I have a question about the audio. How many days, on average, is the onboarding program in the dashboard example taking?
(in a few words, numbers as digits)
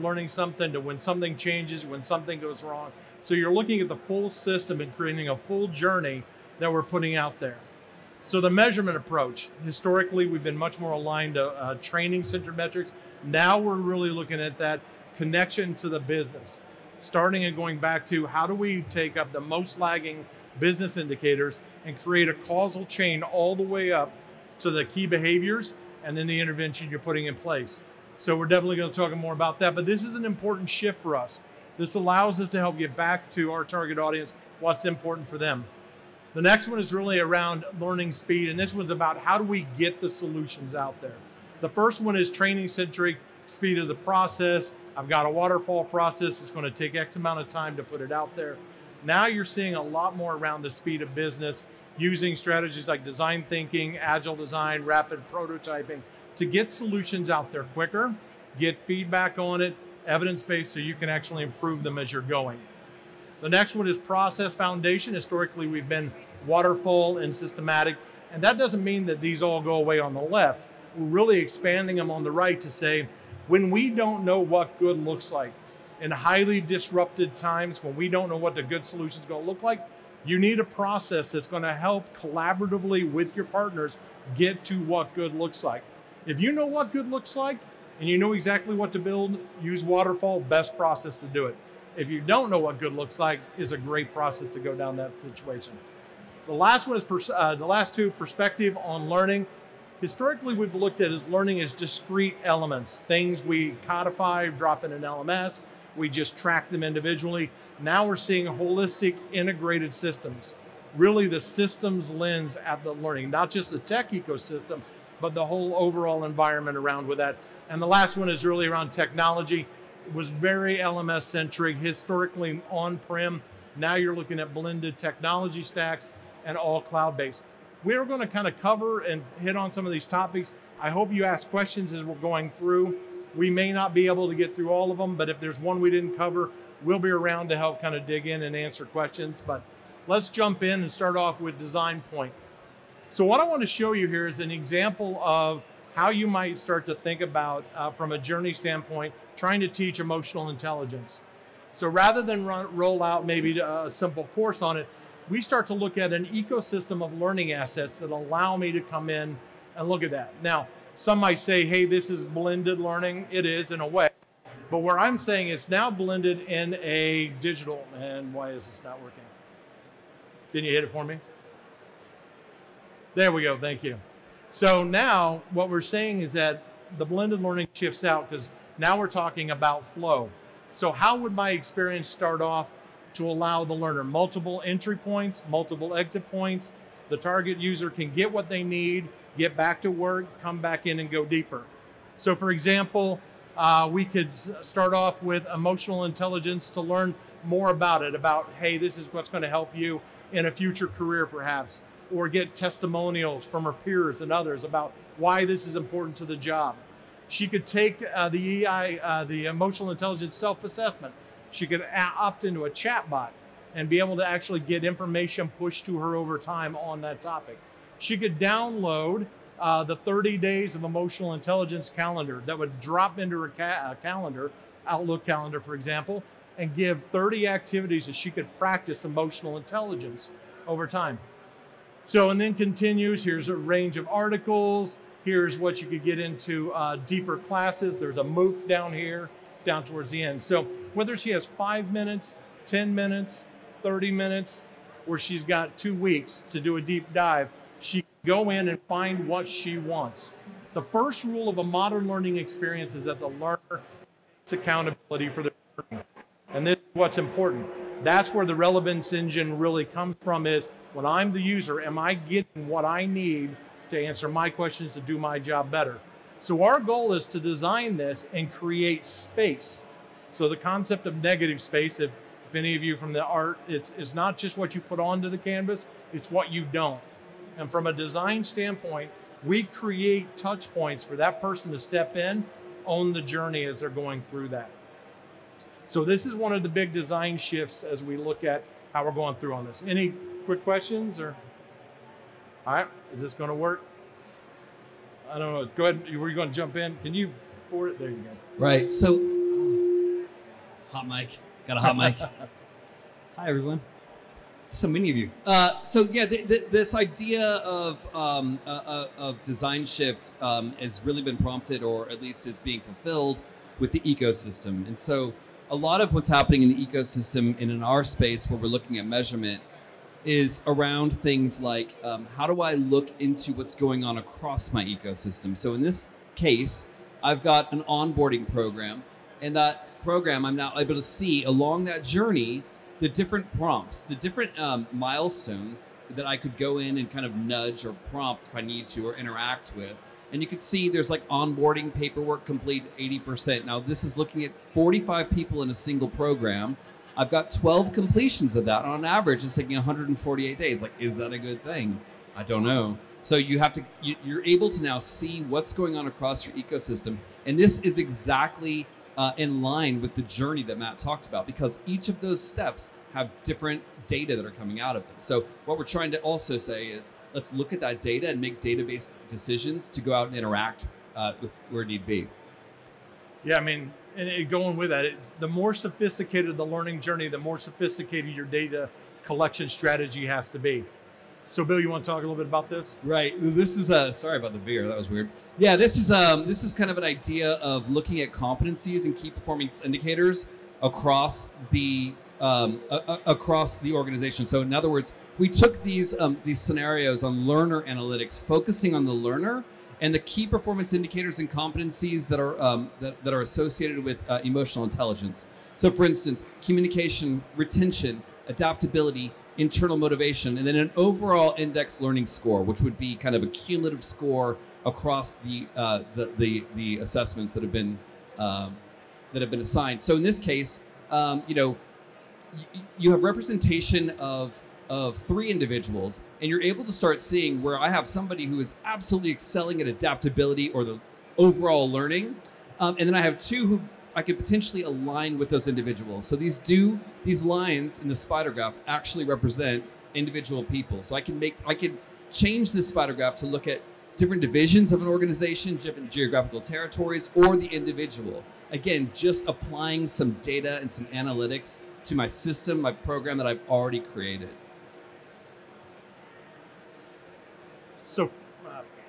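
148.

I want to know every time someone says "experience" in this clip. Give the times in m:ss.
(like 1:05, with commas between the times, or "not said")
3:01, 4:12.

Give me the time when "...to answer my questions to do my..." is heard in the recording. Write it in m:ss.
4:23.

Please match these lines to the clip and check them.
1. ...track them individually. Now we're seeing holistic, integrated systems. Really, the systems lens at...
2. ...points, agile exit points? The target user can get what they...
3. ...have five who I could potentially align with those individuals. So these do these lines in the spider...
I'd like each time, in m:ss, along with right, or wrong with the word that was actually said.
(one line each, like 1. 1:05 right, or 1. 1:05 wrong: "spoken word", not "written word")
1. 1:46 right
2. 3:04 wrong: "multiple", not "agile"
3. 7:13 wrong: "two", not "five".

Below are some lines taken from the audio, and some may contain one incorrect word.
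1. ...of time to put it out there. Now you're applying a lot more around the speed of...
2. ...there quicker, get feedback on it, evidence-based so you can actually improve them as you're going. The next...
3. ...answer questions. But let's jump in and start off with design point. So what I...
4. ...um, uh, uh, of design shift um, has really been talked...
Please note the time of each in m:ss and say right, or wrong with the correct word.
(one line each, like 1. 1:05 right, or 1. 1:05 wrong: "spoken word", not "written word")
1. 0:47 wrong: "seeing", not "applying"
2. 0:57 right
3. 2:18 right
4. 5:08 wrong: "prompted", not "talked".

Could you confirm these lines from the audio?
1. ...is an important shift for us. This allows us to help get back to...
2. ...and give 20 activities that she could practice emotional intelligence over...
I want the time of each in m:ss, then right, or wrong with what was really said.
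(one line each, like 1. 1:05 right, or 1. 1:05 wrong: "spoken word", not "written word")
1. 0:30 right
2. 3:46 wrong: "30", not "20".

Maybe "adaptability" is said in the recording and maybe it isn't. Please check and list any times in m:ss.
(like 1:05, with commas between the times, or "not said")
6:48, 7:09.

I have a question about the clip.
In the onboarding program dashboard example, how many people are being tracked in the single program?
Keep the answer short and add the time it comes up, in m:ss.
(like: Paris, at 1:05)
45, at 5:44.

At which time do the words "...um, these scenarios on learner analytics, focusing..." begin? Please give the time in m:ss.
6:36.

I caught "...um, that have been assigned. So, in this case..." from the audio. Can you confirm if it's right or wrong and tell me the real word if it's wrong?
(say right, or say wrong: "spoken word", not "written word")
right.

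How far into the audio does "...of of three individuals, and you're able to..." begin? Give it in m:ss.
7:04.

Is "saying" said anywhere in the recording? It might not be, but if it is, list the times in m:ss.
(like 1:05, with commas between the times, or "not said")
2:45, 2:55.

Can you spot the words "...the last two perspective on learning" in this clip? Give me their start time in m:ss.
1:37.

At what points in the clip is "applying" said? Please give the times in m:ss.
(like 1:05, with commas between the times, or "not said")
7:29.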